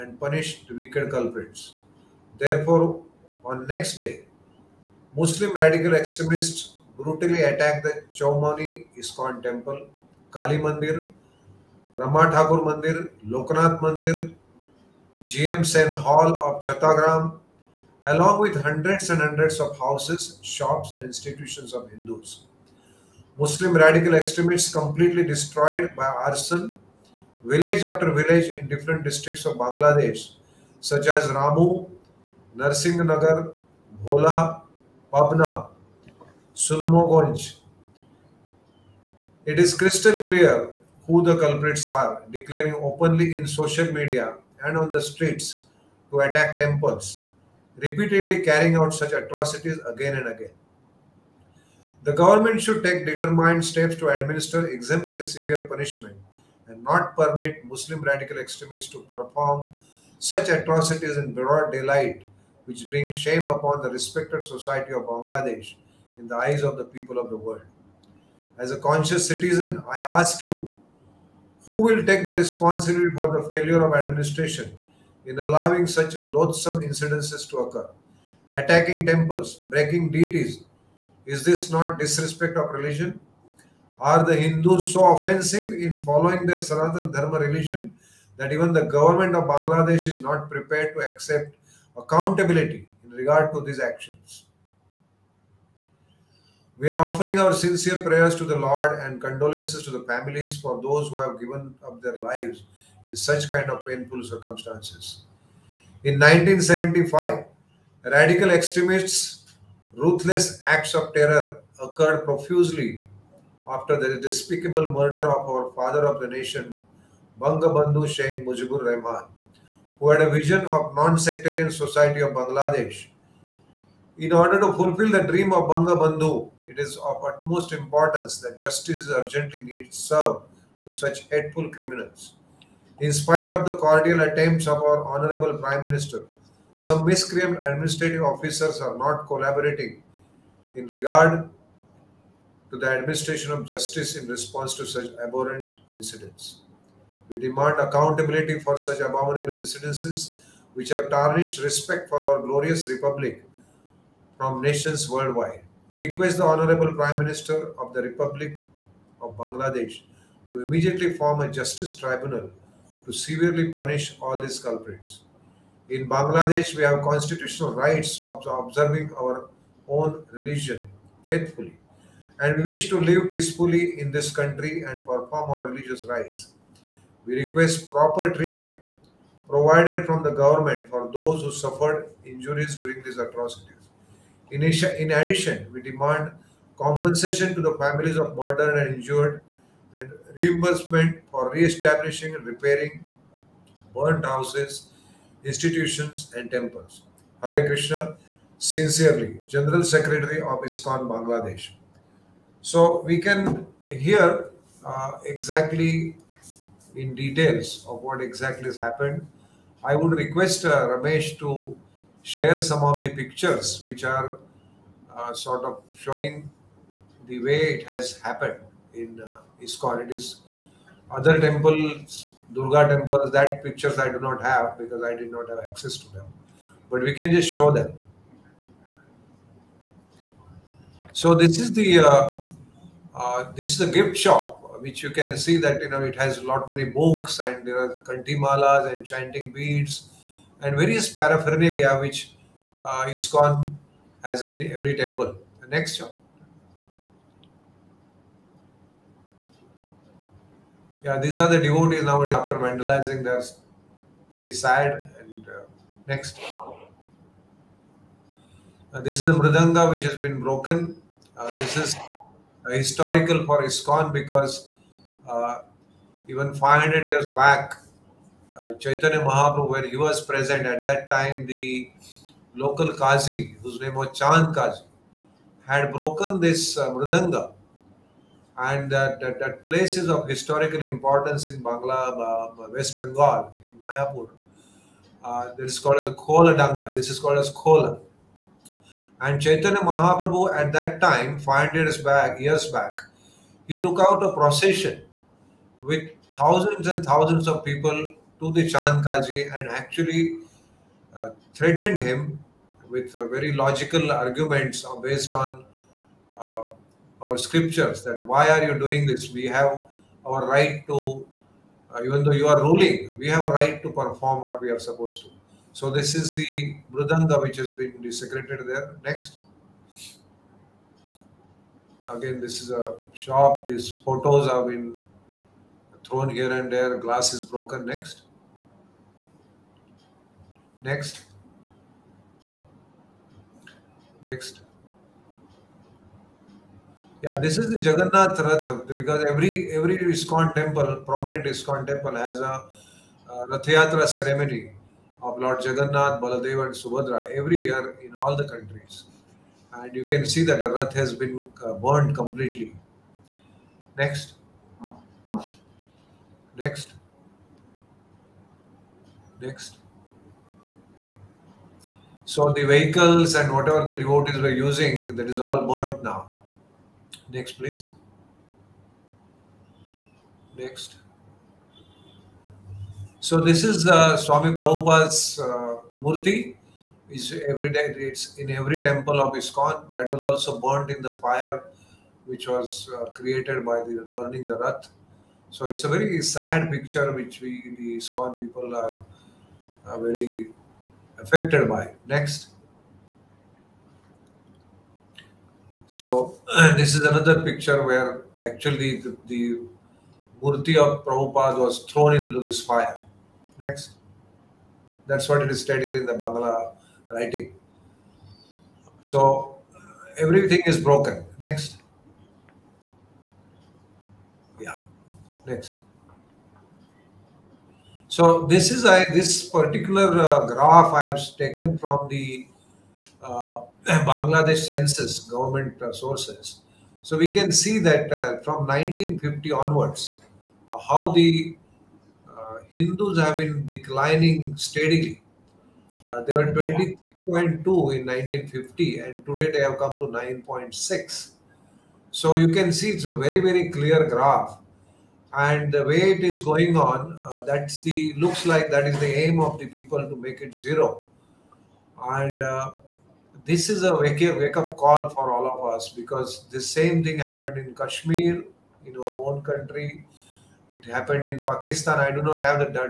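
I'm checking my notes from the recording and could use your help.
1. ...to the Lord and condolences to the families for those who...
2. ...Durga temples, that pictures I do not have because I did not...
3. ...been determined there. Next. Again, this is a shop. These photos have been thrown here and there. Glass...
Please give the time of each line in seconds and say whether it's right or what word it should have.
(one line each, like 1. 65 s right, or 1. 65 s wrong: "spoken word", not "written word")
1. 98 s right
2. 222 s right
3. 317 s wrong: "desecrated", not "determined".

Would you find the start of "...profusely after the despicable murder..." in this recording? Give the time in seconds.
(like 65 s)
112 s.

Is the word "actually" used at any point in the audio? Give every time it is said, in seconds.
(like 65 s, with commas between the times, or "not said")
299 s, 398 s.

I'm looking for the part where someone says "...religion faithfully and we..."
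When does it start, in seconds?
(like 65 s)
170 s.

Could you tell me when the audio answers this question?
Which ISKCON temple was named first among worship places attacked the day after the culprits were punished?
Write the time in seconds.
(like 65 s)
8 s.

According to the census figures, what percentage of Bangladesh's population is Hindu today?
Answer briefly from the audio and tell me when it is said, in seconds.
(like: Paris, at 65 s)
9.6, at 440 s.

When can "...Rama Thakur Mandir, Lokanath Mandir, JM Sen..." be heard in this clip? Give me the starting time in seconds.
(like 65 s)
11 s.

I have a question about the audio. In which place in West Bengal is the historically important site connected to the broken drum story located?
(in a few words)
Mayapur.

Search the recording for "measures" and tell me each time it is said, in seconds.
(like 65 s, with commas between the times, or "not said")
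not said.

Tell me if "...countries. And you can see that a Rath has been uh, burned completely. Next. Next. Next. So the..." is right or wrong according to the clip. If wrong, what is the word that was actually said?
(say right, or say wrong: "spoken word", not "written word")
right.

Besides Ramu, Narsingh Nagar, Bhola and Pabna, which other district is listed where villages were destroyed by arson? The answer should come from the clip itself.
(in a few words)
Sunamganj.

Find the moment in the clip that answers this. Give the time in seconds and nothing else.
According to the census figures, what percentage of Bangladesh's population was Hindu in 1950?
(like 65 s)
436 s.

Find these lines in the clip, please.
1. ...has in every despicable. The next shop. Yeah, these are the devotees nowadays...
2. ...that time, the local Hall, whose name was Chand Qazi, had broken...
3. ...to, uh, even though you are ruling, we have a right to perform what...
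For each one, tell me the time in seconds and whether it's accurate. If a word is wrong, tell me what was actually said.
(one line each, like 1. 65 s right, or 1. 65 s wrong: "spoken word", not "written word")
1. 244 s wrong: "temple", not "despicable"
2. 270 s wrong: "Qazi", not "Hall"
3. 310 s right.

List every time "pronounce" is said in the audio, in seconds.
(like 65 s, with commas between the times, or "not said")
not said.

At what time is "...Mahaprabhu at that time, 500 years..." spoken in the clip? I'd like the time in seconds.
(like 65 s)
289 s.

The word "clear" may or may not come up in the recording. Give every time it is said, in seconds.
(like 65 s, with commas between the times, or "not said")
40 s, 443 s.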